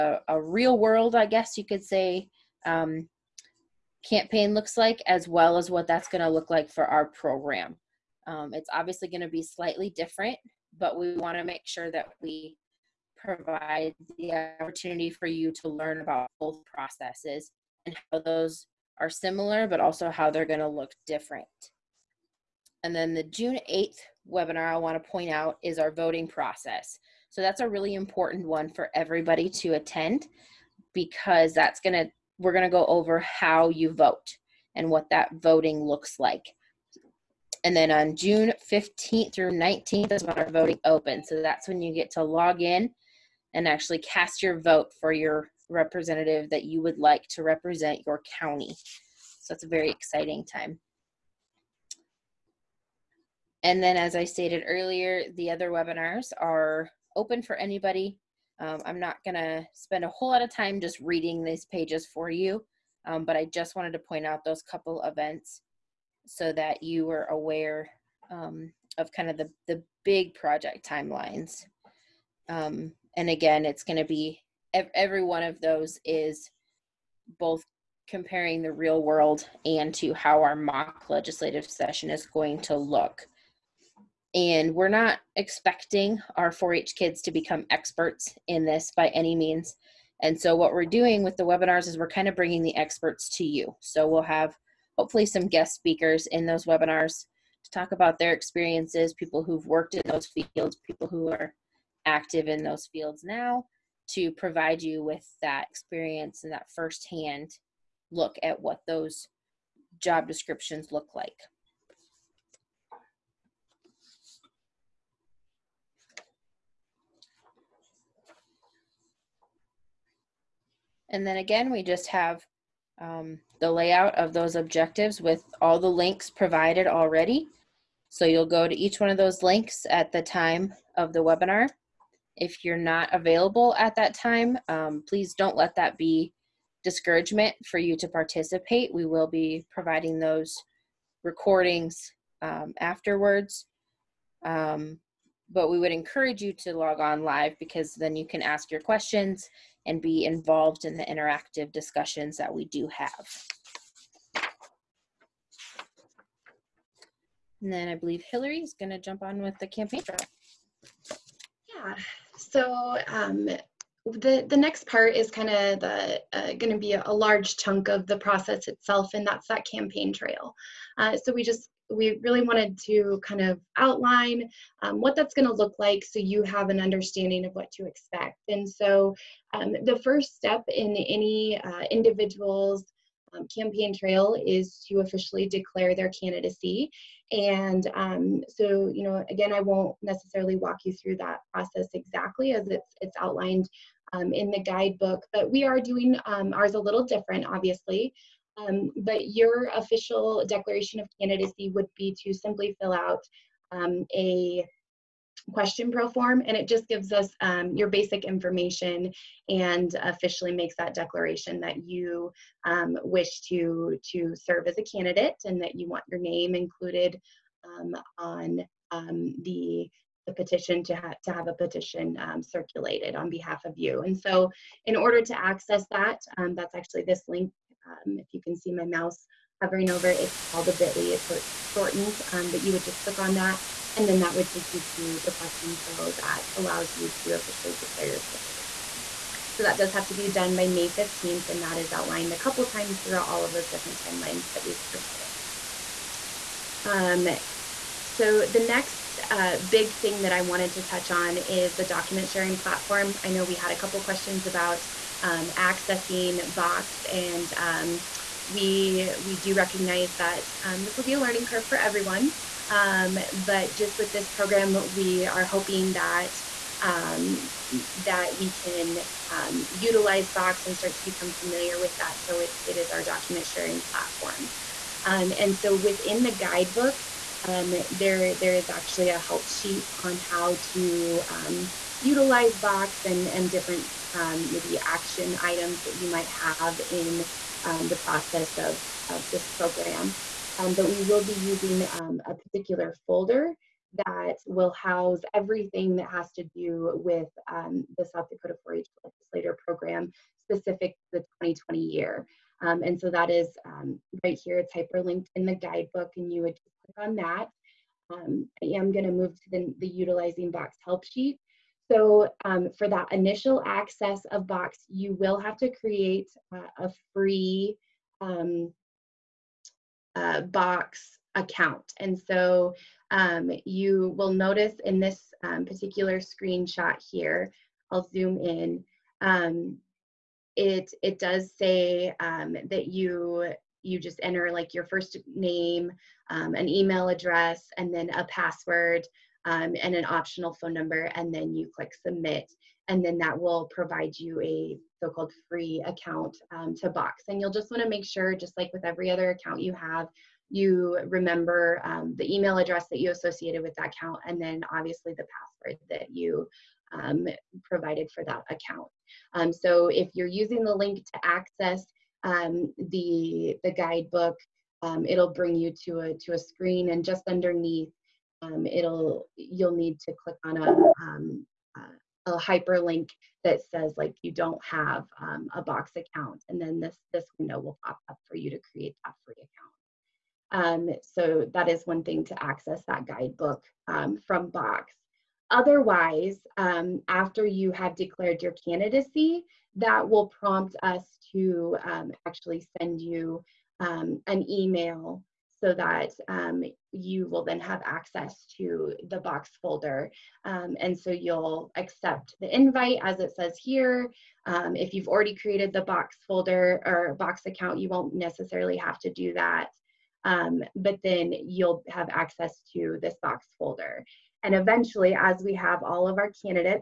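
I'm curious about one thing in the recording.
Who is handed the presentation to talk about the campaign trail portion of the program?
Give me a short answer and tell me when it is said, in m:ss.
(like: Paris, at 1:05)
Hillary, at 2:38.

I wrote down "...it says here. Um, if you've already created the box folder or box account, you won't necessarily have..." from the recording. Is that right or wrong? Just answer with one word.
right.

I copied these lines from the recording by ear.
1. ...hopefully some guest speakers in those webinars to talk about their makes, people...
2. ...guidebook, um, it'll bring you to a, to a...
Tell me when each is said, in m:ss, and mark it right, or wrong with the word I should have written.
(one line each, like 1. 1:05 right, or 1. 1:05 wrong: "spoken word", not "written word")
1. 1:34 wrong: "experiences", not "makes"
2. 6:03 right.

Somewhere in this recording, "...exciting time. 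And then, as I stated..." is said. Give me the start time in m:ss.
0:49.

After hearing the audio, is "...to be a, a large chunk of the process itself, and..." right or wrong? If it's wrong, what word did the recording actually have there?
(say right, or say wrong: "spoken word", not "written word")
right.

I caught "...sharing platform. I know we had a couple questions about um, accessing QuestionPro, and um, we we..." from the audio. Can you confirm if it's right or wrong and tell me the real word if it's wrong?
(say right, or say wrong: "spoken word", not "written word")
wrong: "Box", not "QuestionPro".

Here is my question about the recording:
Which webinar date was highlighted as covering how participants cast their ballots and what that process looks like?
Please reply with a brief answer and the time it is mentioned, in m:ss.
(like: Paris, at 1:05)
June 8th, at 0:23.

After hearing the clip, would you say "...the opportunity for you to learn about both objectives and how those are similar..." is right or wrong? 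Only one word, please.
wrong.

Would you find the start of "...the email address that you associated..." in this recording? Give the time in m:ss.
5:52.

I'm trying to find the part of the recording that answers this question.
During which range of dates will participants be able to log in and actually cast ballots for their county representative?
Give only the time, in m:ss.
0:38.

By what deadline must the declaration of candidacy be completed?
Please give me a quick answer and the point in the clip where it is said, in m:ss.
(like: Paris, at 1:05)
May 15th, at 4:00.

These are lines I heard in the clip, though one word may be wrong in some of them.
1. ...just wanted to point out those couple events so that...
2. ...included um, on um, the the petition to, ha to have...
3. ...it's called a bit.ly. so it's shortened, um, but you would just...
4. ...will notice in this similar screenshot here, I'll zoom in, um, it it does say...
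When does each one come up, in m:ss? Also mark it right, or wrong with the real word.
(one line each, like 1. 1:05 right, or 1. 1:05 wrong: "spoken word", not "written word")
1. 1:03 right
2. 3:36 right
3. 3:50 right
4. 5:24 wrong: "particular", not "similar".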